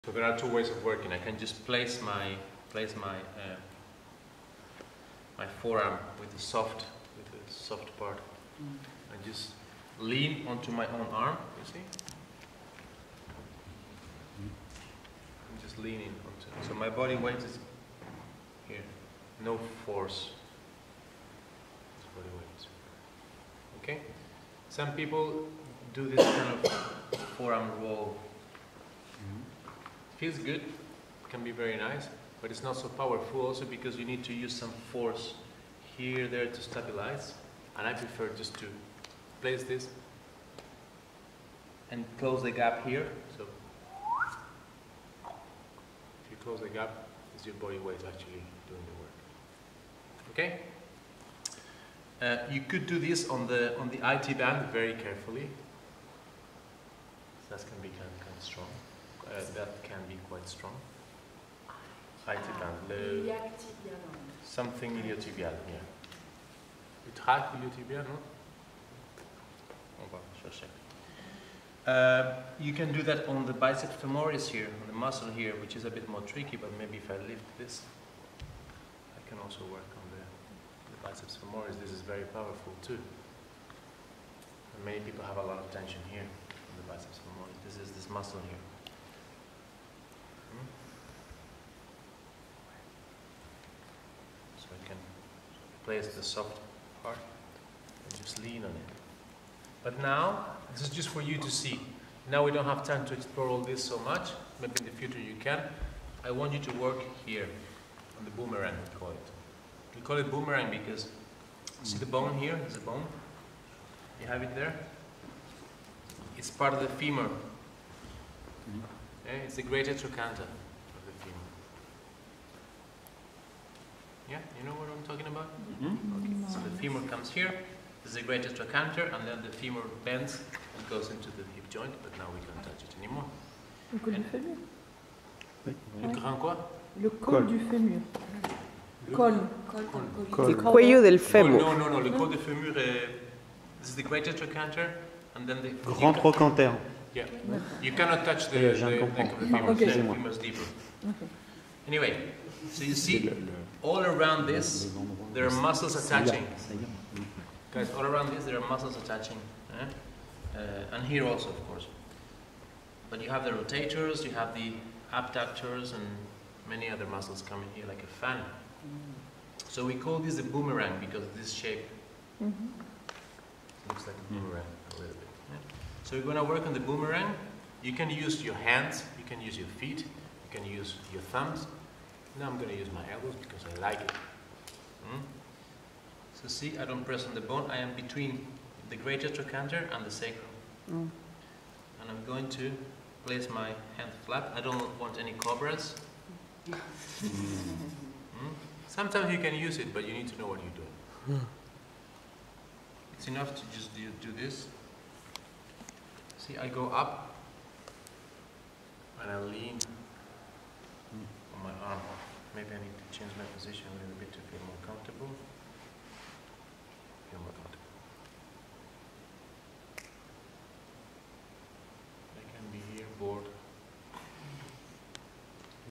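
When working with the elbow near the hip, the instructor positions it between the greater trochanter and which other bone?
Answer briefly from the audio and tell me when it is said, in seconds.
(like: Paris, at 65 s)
sacrum, at 190 s.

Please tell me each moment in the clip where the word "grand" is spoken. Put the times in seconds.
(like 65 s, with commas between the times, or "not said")
136 s, 145 s.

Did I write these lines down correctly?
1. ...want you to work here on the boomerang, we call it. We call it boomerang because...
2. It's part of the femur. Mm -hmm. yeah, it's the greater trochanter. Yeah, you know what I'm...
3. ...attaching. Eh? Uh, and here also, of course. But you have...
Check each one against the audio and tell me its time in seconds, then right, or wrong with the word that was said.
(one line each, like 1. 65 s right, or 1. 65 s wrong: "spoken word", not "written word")
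1. 106 s right
2. 116 s right
3. 158 s right.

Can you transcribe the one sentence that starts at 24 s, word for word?
Some people do this kind of forearm roll.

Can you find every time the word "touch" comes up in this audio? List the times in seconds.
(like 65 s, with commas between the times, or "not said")
132 s, 148 s.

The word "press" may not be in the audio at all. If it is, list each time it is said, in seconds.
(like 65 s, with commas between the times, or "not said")
187 s.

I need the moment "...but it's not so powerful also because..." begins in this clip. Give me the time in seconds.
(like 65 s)
32 s.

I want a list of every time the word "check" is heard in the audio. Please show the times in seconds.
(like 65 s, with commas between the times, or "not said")
not said.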